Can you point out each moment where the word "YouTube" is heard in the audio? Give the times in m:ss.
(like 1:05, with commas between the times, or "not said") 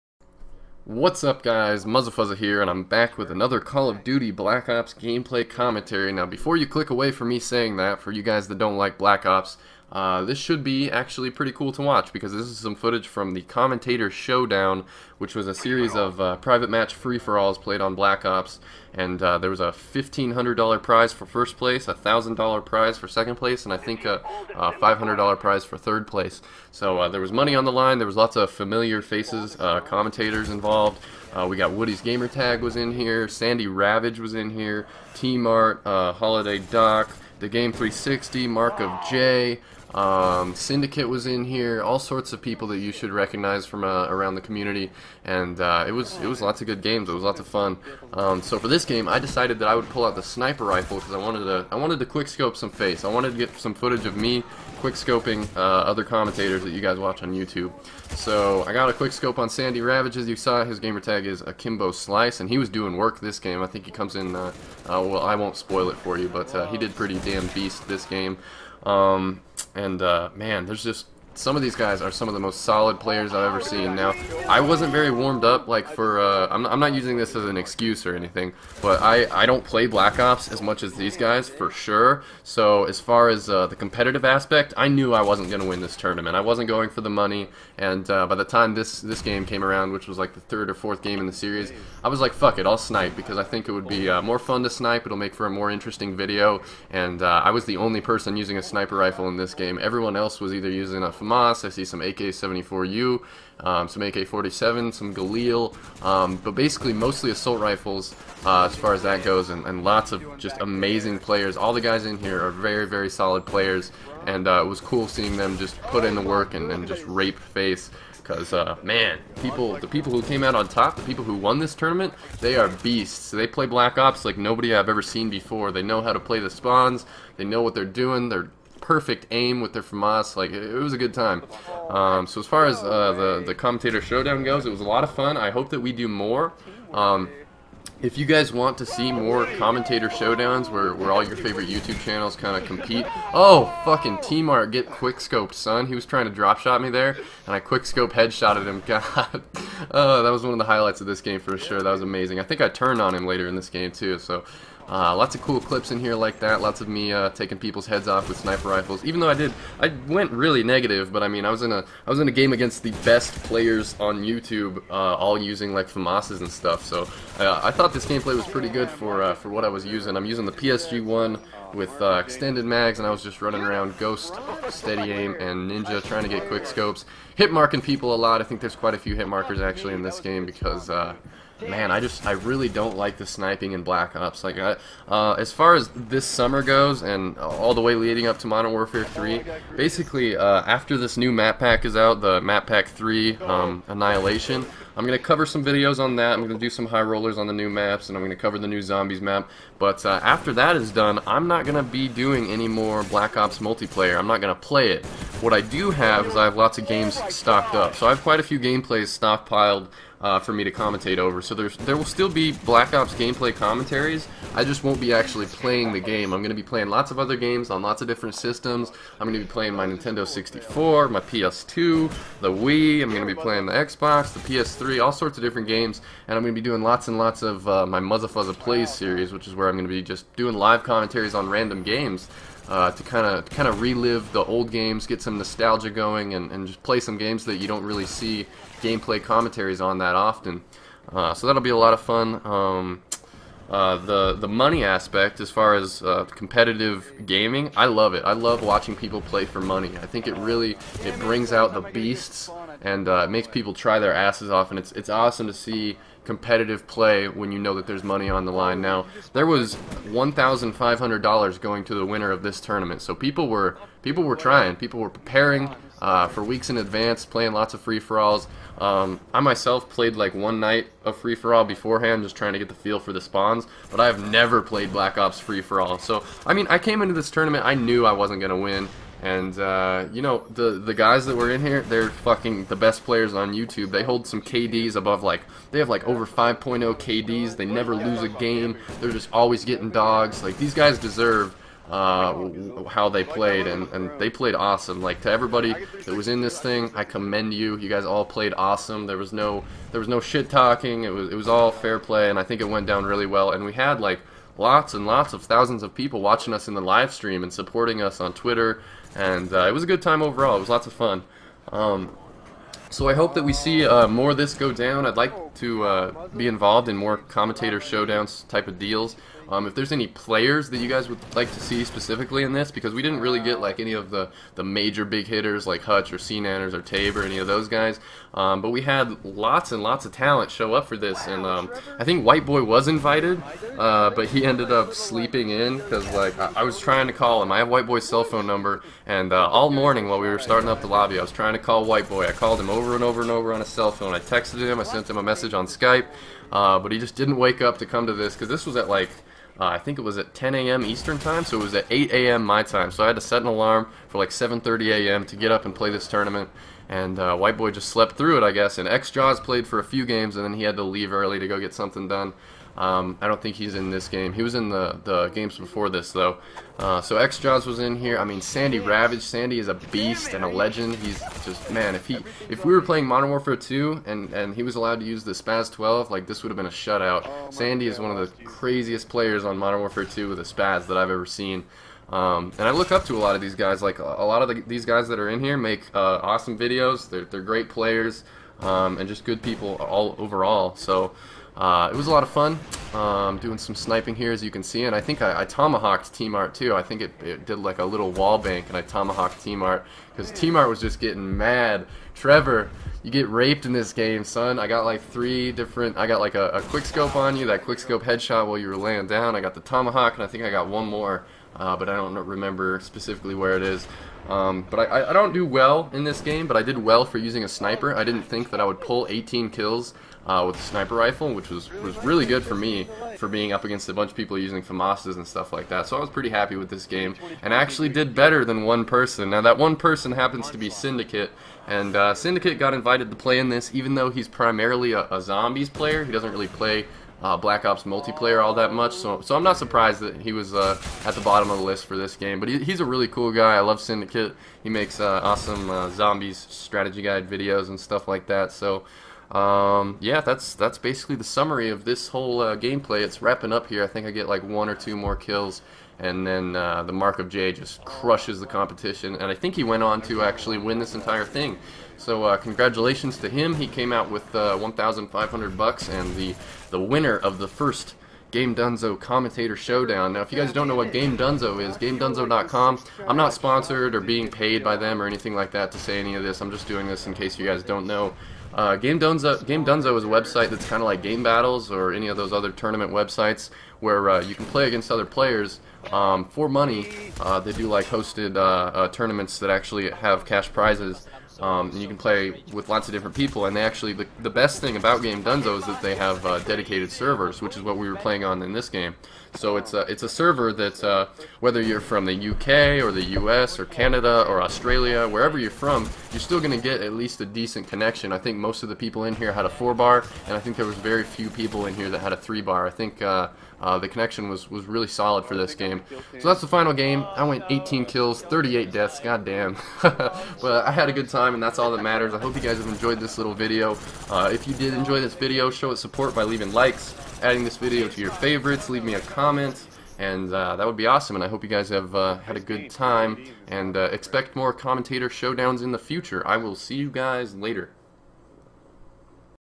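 0:57, 2:21, 2:44, 4:43.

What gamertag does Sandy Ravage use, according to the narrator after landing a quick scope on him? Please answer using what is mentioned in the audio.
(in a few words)
Akimbo Slice.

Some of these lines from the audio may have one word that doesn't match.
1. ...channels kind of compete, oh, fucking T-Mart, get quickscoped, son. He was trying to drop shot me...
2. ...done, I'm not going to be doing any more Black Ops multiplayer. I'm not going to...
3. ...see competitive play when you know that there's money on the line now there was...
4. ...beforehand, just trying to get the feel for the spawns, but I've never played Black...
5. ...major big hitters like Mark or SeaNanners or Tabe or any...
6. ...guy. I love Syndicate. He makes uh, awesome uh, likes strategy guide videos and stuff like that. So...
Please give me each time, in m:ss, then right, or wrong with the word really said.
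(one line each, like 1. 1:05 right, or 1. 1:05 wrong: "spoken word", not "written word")
1. 2:22 right
2. 3:20 right
3. 4:15 right
4. 4:31 right
5. 5:24 wrong: "Hutch", not "Mark"
6. 7:23 wrong: "zombies", not "likes".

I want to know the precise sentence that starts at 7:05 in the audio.
So I was pretty happy with this game and actually did better than one person.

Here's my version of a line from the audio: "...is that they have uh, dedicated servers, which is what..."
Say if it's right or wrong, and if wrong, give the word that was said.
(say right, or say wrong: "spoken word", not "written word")
right.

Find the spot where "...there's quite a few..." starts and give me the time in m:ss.
2:58.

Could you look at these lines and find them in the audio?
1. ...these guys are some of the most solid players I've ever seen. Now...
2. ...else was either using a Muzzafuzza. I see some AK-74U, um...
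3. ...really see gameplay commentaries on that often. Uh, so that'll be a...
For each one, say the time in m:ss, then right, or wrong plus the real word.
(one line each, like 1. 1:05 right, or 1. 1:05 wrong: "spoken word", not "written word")
1. 1:11 right
2. 1:40 wrong: "FAMAS", not "Muzzafuzza"
3. 3:57 right.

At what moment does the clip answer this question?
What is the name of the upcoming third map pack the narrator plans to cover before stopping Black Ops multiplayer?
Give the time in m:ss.
3:13.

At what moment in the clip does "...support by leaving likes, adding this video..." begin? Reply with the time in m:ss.
8:45.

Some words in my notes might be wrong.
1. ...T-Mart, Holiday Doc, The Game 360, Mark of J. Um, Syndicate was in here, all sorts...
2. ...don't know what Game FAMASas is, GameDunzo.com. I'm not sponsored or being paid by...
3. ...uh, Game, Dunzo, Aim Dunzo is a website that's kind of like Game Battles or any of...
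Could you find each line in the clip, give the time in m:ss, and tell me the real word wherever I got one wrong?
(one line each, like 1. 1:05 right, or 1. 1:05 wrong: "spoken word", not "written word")
1. 0:35 right
2. 7:50 wrong: "Dunzo", not "FAMASas"
3. 7:58 wrong: "Game", not "Aim".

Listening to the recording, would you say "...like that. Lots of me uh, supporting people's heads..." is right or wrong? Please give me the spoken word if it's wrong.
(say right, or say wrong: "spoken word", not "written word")
wrong: "taking", not "supporting".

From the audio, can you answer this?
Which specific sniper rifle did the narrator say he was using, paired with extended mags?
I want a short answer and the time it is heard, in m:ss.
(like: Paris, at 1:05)
PSG1, at 2:50.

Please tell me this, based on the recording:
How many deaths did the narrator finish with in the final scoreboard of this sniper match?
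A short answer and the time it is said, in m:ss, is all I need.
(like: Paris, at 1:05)
38, at 8:38.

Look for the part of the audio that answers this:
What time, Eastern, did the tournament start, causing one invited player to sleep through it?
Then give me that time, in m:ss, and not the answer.
5:50.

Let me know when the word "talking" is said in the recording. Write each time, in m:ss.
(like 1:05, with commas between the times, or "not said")
5:00.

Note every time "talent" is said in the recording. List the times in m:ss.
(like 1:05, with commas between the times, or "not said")
5:30.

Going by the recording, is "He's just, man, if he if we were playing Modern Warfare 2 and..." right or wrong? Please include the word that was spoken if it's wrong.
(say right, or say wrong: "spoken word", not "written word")
right.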